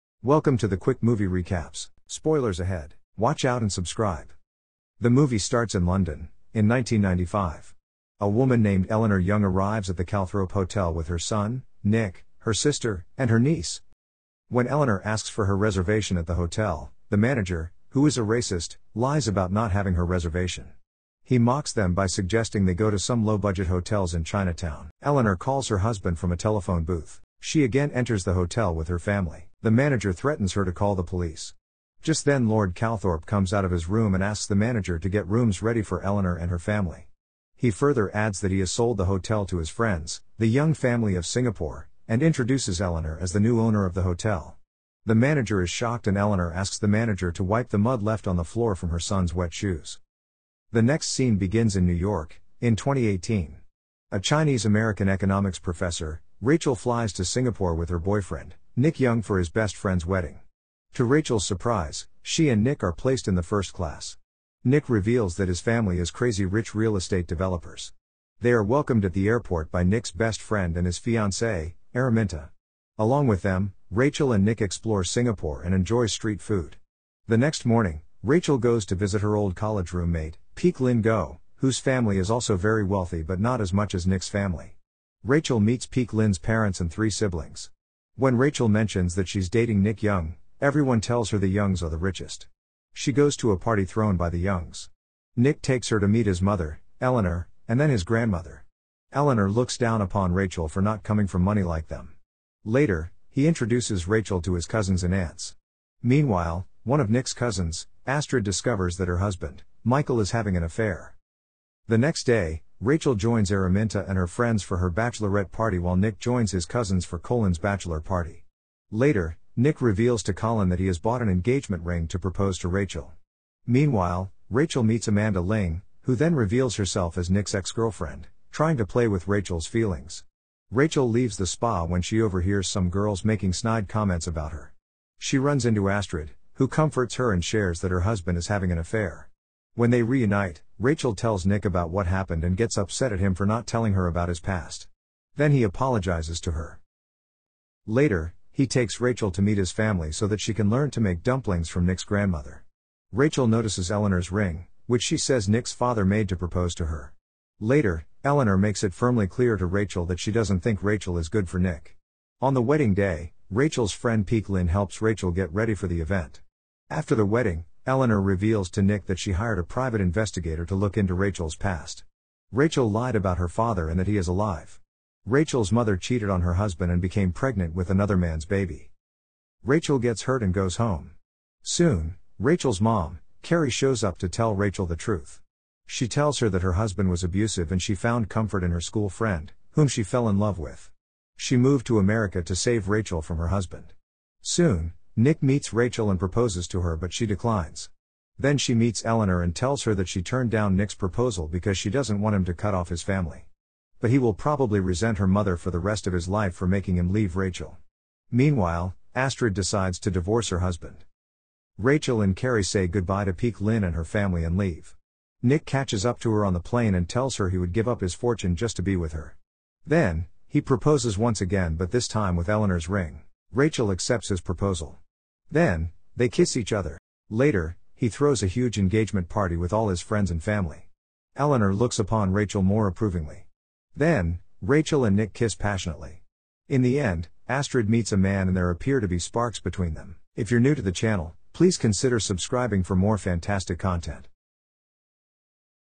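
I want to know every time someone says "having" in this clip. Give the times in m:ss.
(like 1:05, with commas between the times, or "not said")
0:19, 1:50, 2:18.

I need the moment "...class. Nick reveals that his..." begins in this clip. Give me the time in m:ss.
1:03.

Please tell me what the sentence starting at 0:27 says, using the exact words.
She again enters the hotel with her family.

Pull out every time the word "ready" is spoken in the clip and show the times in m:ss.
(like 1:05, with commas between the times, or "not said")
0:35, 2:45.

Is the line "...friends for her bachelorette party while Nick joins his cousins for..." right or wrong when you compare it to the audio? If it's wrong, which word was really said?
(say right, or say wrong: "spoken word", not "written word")
right.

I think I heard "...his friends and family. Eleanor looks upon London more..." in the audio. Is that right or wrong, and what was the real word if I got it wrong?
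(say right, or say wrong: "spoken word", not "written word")
wrong: "Rachel", not "London".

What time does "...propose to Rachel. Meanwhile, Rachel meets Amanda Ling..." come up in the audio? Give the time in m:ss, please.
2:02.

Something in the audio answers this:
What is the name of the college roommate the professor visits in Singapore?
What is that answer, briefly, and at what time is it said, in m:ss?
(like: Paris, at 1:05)
Peik Lin Goh, at 1:20.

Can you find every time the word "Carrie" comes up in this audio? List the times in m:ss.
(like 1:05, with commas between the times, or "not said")
3:03, 3:32.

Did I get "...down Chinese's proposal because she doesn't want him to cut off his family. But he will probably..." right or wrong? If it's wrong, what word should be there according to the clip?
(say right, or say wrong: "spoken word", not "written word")
wrong: "Nick", not "Chinese".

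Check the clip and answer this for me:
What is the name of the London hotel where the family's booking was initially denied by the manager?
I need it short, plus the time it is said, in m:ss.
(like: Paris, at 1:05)
Calthorpe Hotel, at 0:10.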